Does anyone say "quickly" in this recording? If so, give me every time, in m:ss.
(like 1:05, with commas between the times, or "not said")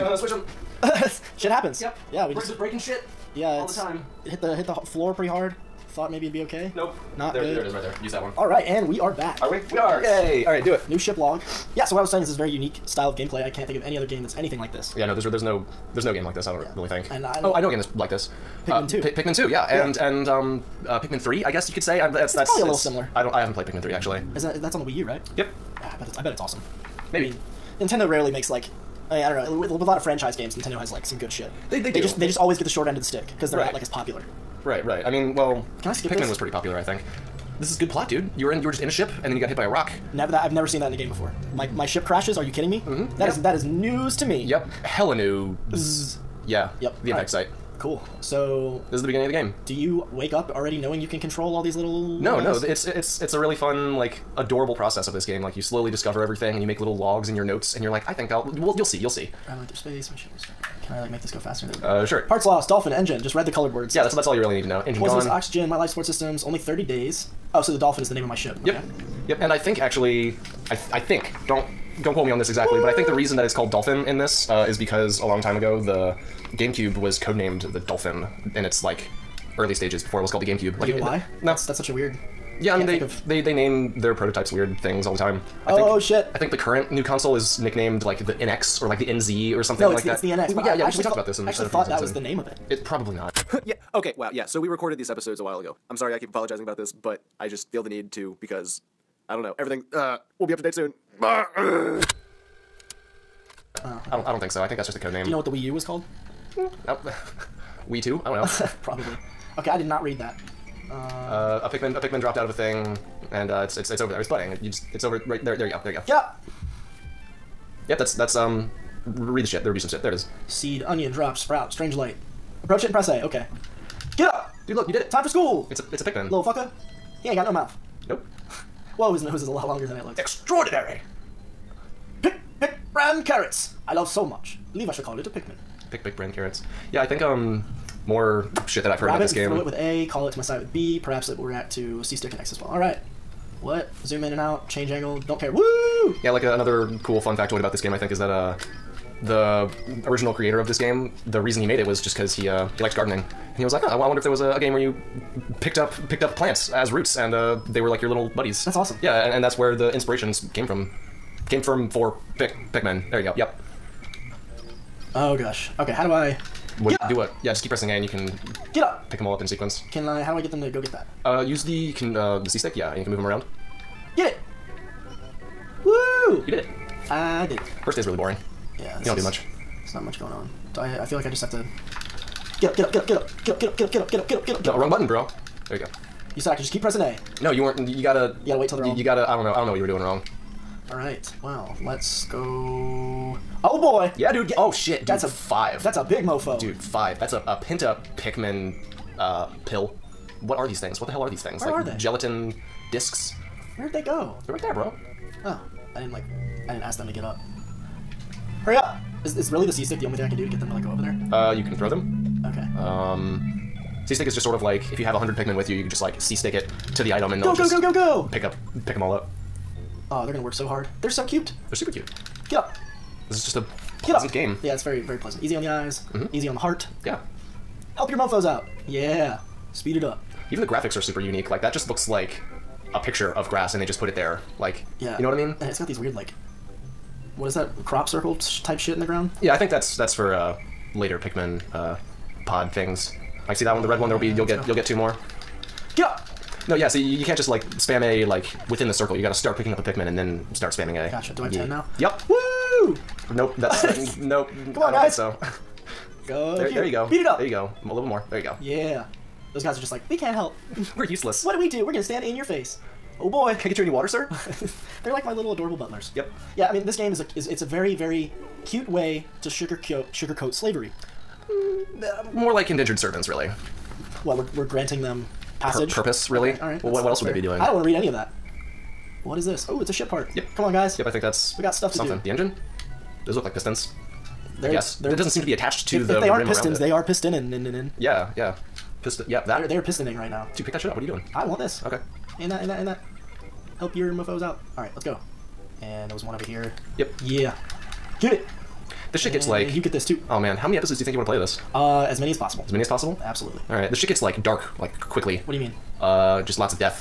5:05.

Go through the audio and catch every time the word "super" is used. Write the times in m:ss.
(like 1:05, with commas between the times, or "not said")
3:41, 3:51.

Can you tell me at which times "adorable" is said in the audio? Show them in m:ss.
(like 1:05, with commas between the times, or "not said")
0:54, 4:25.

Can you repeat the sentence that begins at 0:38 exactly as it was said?
You were in, you were just in a ship, and then you got hit by a rock.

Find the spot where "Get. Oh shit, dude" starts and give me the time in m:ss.
3:14.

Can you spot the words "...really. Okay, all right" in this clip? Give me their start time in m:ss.
4:36.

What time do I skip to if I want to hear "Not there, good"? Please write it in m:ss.
0:07.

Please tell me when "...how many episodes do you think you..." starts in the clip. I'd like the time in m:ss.
5:00.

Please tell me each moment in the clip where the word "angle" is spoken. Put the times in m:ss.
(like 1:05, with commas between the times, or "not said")
2:24.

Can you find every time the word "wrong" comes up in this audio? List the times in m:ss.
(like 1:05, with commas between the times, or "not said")
3:04, 3:09.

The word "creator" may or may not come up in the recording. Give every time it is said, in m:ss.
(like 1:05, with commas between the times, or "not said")
2:30.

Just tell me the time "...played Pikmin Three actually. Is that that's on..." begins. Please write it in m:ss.
0:23.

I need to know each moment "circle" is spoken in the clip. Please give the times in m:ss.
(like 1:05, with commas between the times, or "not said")
3:58, 4:08.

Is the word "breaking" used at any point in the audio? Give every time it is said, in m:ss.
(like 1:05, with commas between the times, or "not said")
0:02.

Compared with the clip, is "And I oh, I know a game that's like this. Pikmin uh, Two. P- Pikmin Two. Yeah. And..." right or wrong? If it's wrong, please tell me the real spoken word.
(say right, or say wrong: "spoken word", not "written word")
right.